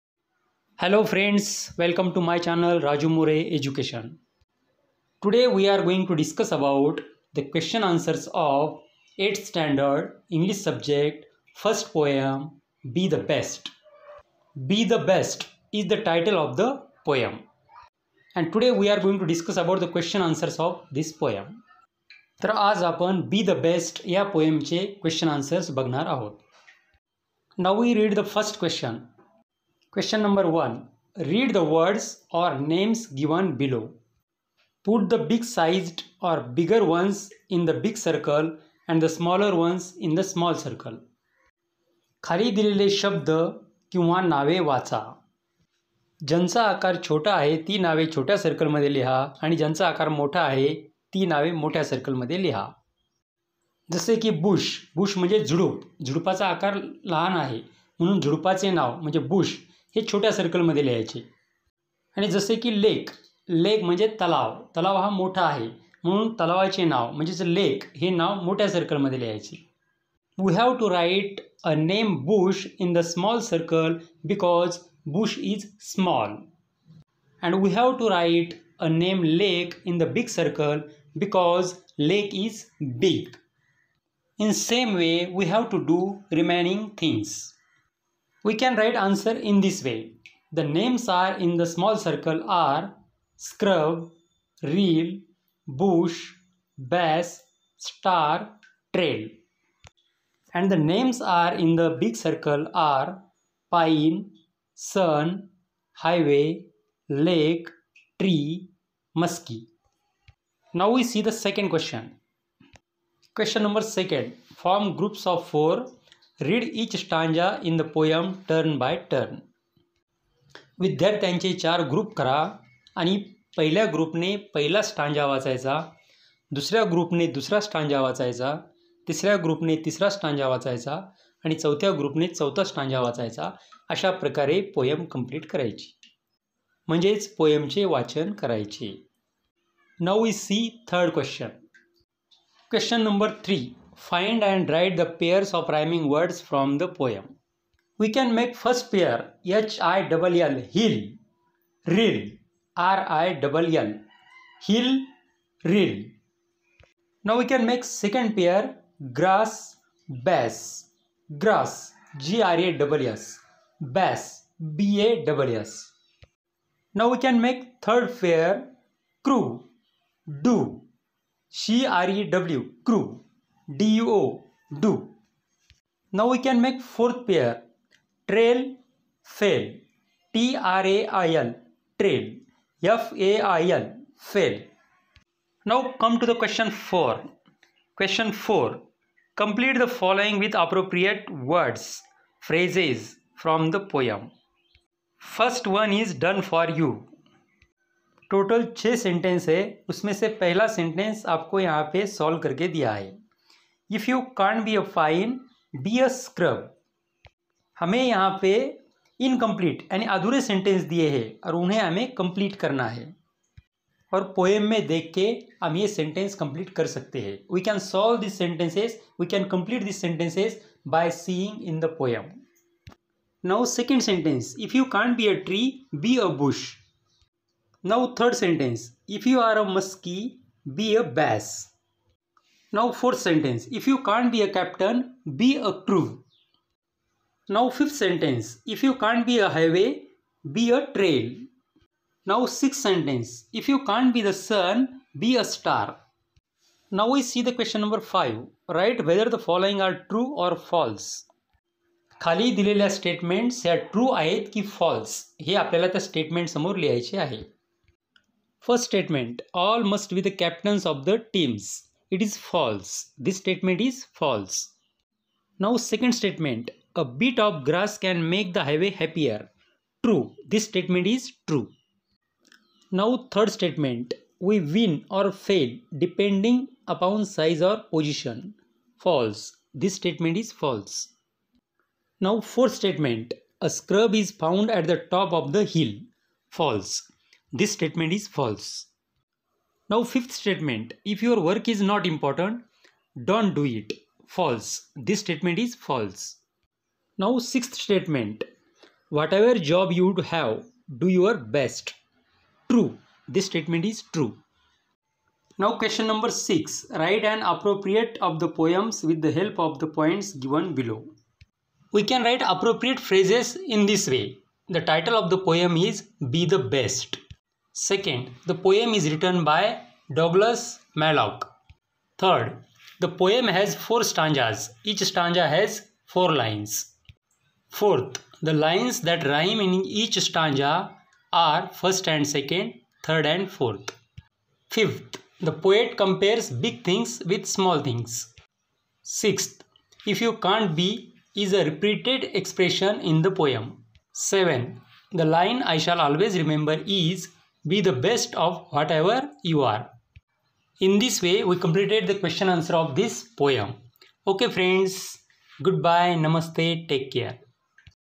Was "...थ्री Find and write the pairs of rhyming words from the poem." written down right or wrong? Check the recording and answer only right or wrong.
right.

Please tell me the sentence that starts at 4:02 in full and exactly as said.
Now sixth sentence, if you can't be the sun, be a star.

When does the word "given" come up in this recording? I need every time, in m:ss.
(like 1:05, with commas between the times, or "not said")
5:10.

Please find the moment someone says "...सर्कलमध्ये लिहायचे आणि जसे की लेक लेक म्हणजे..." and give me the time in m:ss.
1:00.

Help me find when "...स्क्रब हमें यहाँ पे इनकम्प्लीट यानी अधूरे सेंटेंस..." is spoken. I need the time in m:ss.
3:26.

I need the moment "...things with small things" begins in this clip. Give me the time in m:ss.
5:36.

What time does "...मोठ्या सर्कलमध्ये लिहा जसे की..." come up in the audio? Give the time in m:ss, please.
0:51.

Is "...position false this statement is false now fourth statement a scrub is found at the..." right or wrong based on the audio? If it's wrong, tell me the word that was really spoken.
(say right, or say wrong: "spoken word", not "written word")
right.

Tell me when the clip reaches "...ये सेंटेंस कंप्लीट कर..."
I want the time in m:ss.
3:35.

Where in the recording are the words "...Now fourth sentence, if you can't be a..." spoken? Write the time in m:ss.
3:52.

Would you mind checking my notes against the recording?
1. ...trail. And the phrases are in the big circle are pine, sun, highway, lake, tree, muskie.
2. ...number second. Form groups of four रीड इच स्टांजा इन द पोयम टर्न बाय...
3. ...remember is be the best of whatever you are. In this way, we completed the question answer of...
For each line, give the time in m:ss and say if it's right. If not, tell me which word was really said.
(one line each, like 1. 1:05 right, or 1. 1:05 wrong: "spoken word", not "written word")
1. 1:38 wrong: "names", not "phrases"
2. 1:53 right
3. 5:46 right.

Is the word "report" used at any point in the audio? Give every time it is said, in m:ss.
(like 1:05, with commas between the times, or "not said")
not said.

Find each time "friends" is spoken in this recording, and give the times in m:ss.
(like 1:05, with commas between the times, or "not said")
0:01, 5:54.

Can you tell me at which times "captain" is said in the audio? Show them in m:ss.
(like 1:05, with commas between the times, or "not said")
3:54, 4:20.